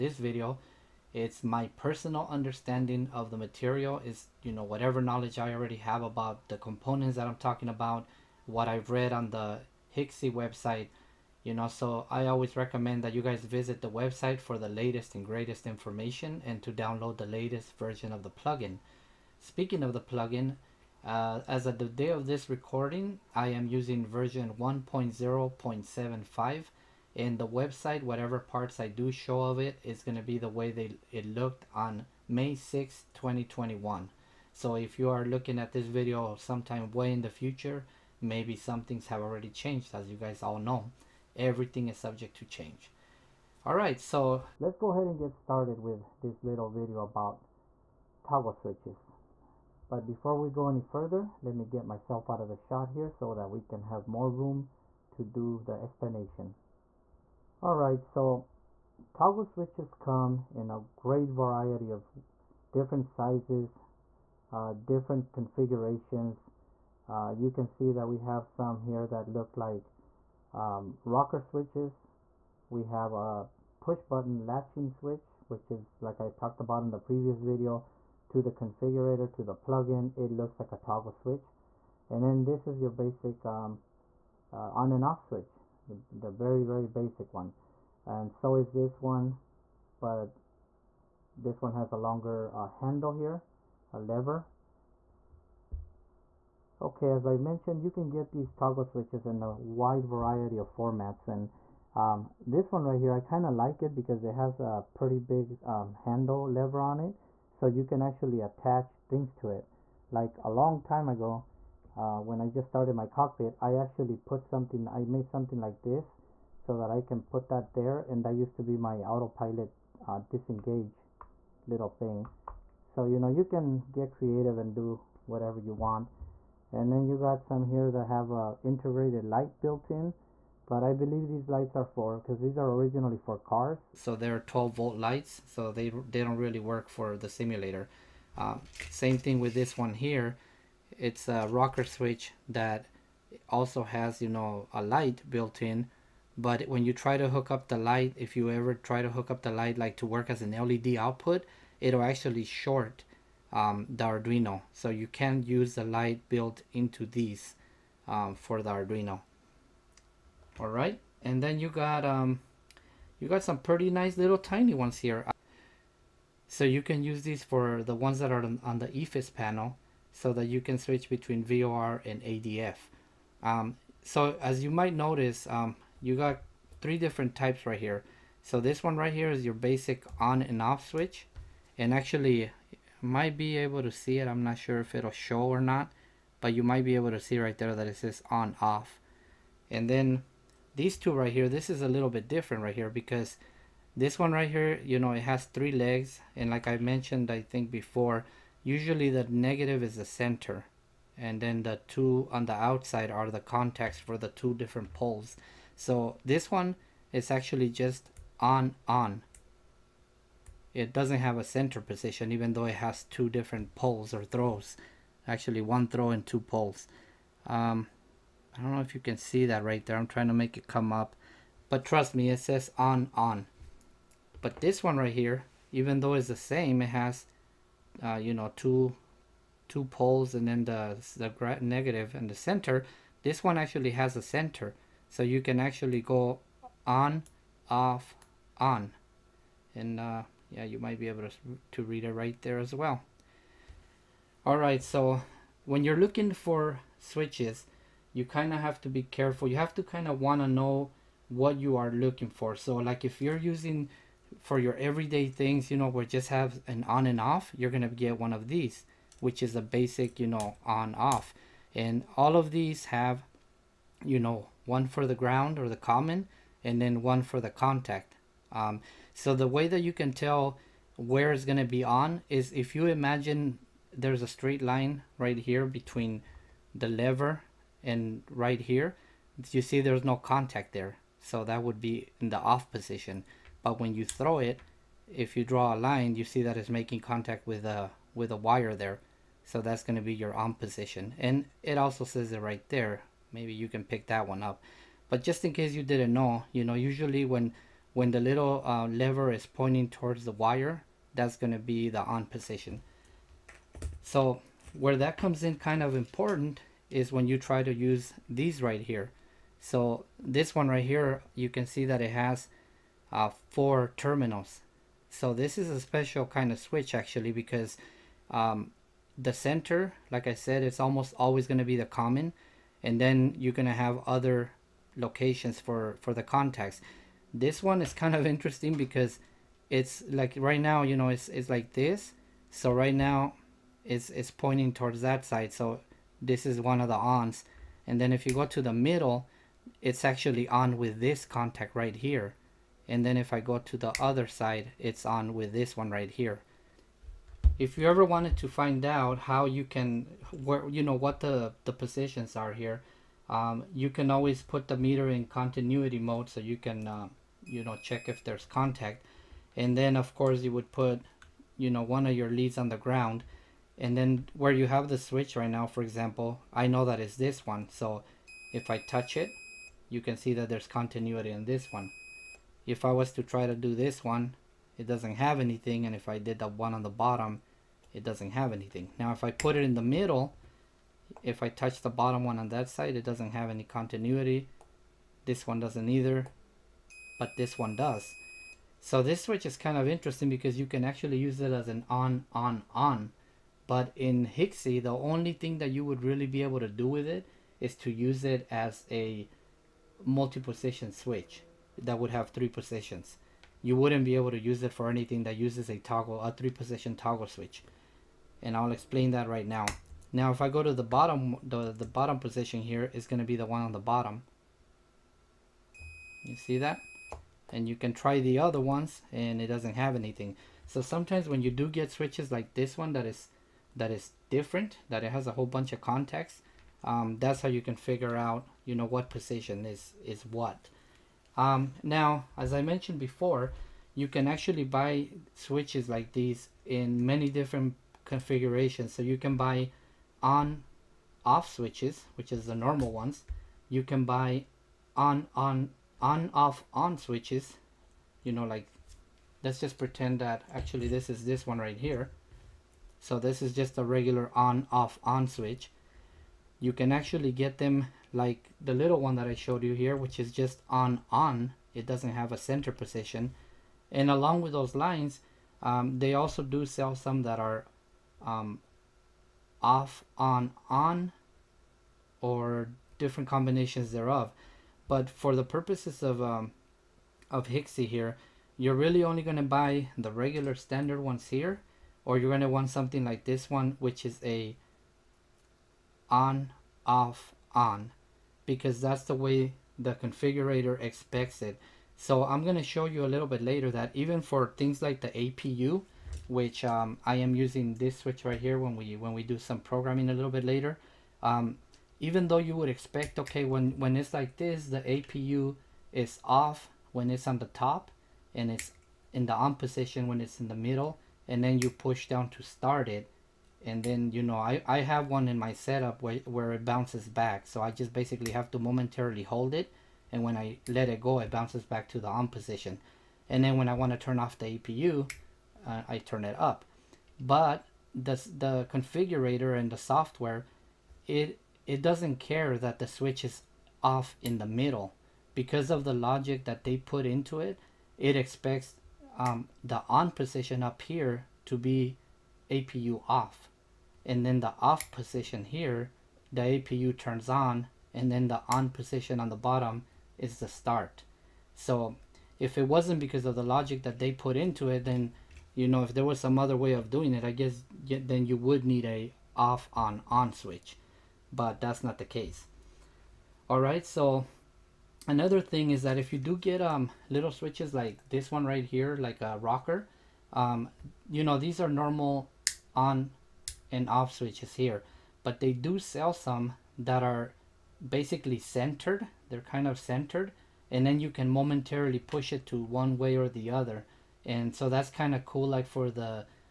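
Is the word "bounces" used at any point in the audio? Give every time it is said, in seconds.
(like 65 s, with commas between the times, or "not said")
516 s, 521 s.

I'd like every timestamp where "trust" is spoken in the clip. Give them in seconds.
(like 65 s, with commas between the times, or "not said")
221 s.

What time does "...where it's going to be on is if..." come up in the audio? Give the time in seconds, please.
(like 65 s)
270 s.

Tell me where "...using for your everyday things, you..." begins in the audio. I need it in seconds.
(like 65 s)
253 s.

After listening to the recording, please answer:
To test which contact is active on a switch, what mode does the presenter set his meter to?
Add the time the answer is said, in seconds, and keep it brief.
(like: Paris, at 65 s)
continuity mode, at 355 s.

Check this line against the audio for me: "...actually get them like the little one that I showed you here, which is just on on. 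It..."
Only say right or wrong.
right.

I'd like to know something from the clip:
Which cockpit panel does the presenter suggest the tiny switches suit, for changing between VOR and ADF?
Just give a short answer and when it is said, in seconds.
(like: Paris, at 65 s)
EFIS panel, at 168 s.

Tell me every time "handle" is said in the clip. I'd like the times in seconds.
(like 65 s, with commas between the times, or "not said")
92 s, 105 s.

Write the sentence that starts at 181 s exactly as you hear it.
And actually might be able to see it.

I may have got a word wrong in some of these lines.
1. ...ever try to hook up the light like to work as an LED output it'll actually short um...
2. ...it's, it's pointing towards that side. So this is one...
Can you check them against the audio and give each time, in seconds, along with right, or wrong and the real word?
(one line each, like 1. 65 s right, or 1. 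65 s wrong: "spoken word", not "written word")
1. 148 s right
2. 333 s right.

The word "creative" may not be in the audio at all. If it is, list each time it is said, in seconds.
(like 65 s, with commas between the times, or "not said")
124 s.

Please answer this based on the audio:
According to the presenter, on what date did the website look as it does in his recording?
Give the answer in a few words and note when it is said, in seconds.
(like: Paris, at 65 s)
May 6, 2021, at 32 s.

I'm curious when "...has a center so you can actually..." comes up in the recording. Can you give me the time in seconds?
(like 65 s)
233 s.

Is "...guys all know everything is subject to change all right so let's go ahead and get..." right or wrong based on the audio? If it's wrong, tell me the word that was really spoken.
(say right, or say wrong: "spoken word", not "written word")
right.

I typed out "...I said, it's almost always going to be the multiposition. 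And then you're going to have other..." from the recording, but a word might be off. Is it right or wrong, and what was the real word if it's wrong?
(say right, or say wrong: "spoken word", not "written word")
wrong: "common", not "multiposition".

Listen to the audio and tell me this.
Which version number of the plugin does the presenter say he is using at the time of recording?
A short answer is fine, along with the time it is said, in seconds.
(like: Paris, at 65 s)
1.0.75, at 24 s.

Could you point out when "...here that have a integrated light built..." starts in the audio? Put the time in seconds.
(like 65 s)
127 s.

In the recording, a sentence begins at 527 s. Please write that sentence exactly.
But the, the configurator and the software, it, it doesn't care that the switch is off in the middle.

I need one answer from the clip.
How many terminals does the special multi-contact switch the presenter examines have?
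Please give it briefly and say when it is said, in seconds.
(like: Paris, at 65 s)
4, at 313 s.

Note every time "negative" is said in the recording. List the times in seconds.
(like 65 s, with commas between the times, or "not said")
199 s, 231 s.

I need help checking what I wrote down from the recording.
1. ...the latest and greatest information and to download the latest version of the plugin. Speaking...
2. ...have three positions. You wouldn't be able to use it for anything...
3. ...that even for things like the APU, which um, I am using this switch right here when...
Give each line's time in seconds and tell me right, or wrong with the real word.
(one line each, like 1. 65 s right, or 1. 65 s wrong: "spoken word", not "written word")
1. 14 s right
2. 402 s right
3. 493 s right.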